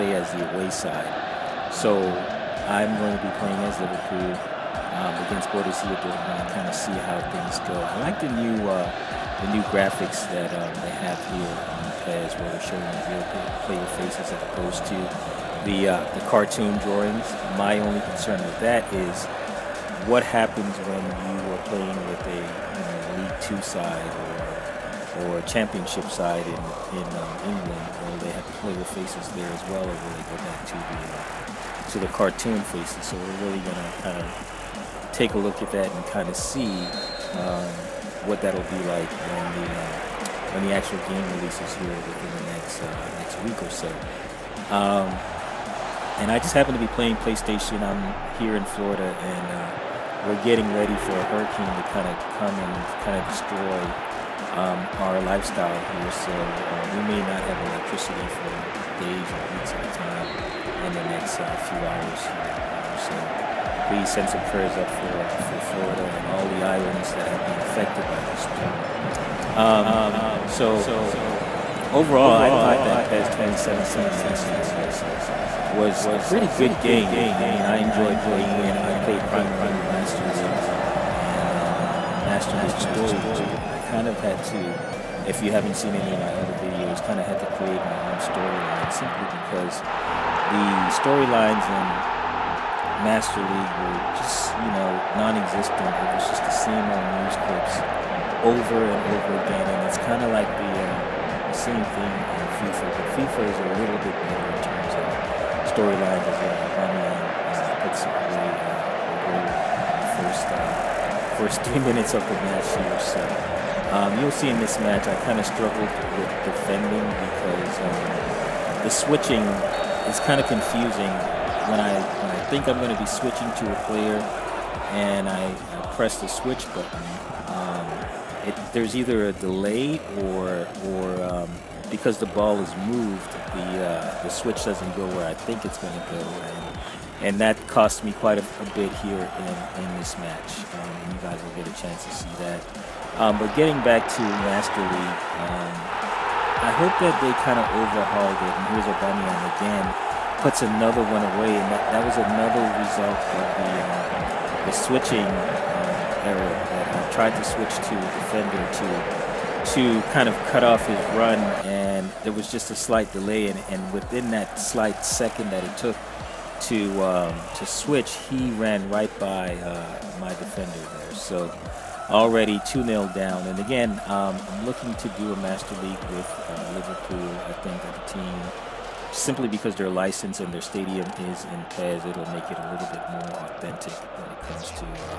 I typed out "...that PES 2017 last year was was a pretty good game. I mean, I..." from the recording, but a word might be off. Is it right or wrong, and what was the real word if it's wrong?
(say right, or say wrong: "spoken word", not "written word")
right.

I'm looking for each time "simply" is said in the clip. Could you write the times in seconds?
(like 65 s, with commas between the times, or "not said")
88 s, 179 s.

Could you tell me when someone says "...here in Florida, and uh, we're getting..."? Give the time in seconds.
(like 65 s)
48 s.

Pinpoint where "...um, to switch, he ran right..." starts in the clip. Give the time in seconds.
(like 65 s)
167 s.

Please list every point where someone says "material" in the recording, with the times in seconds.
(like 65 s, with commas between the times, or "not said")
not said.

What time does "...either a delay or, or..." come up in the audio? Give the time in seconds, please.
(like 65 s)
128 s.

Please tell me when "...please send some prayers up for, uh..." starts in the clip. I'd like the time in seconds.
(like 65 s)
63 s.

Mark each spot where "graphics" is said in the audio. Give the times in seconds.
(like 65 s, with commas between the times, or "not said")
9 s.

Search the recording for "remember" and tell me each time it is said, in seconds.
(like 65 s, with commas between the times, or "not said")
not said.